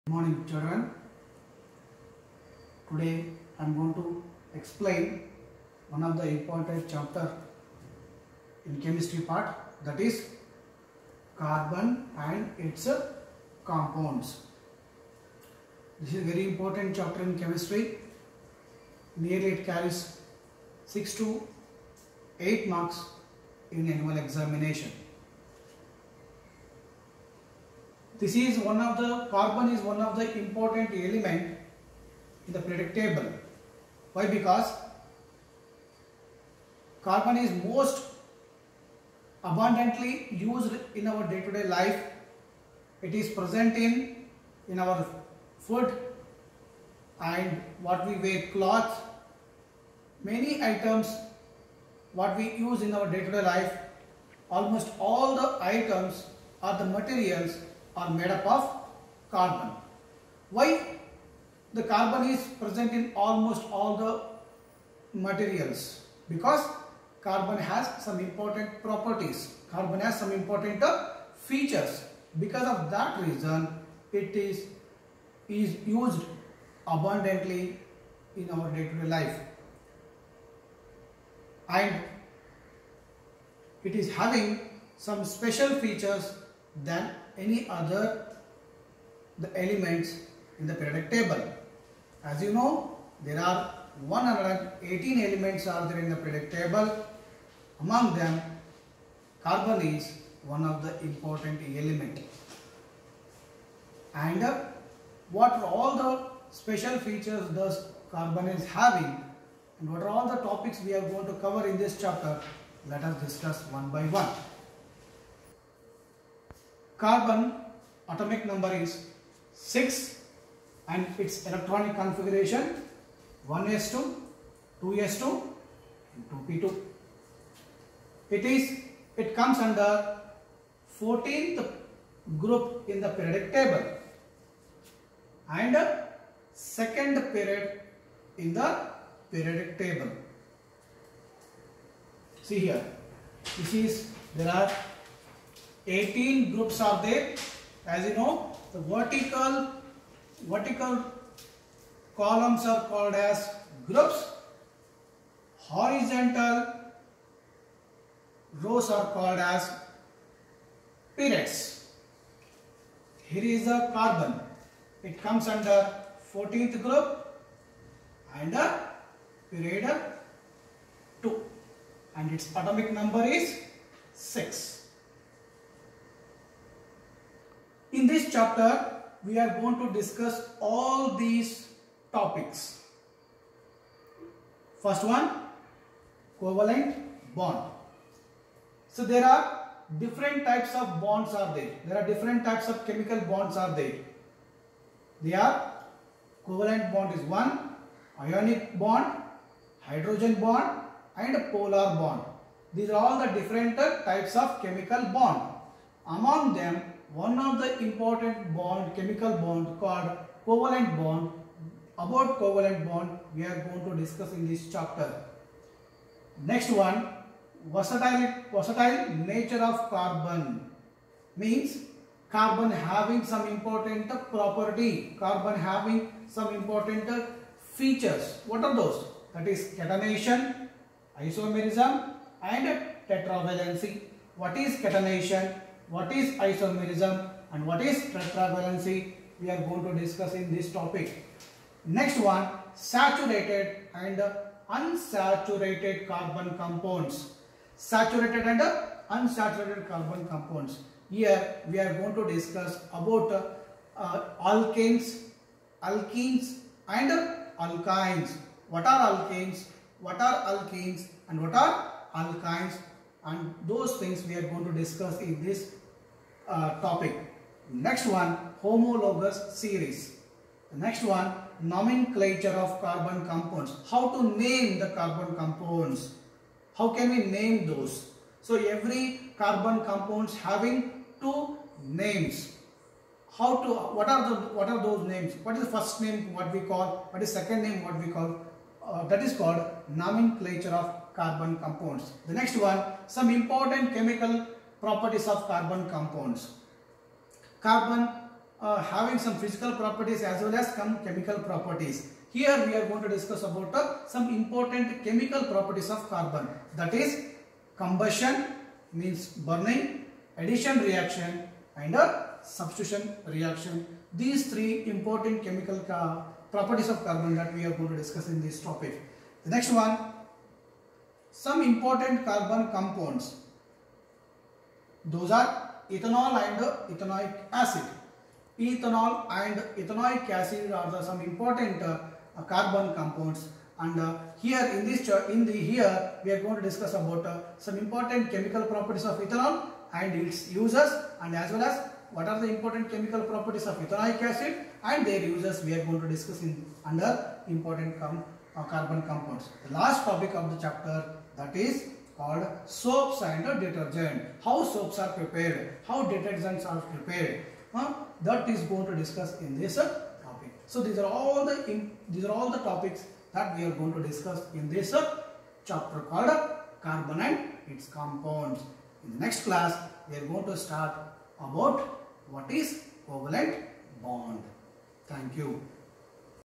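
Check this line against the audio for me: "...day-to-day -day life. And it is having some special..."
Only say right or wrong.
right.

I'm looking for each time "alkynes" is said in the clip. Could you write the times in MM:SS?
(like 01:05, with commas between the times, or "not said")
04:17, 04:22.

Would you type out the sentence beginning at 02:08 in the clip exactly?
It is, it comes under 14th group in the periodic table and second period in the periodic table.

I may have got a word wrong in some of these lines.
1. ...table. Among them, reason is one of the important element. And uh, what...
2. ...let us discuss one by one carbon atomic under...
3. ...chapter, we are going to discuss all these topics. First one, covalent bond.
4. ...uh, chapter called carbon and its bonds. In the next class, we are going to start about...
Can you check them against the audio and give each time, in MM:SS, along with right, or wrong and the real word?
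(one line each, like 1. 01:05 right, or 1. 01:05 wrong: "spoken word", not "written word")
1. 01:36 wrong: "carbon", not "reason"
2. 01:52 wrong: "number", not "under"
3. 02:58 right
4. 06:04 wrong: "compounds", not "bonds".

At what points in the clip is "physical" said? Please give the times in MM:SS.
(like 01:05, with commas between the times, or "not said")
04:59.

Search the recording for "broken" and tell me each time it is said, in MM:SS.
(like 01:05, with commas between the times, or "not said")
not said.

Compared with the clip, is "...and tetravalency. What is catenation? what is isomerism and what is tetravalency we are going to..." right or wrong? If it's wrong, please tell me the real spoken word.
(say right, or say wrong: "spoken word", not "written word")
right.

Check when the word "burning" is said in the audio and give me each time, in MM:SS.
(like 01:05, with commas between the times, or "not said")
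05:09.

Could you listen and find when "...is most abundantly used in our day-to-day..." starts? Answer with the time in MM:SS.
00:37.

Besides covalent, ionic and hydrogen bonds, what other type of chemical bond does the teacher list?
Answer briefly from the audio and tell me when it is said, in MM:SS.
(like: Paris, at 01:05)
polar bond, at 03:21.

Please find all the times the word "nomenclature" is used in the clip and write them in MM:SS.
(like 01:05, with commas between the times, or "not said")
04:31, 04:49.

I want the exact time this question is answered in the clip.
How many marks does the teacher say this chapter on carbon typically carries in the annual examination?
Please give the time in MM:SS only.
00:20.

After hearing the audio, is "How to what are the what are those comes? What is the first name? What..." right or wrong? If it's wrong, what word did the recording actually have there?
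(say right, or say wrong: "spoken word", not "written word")
wrong: "names", not "comes".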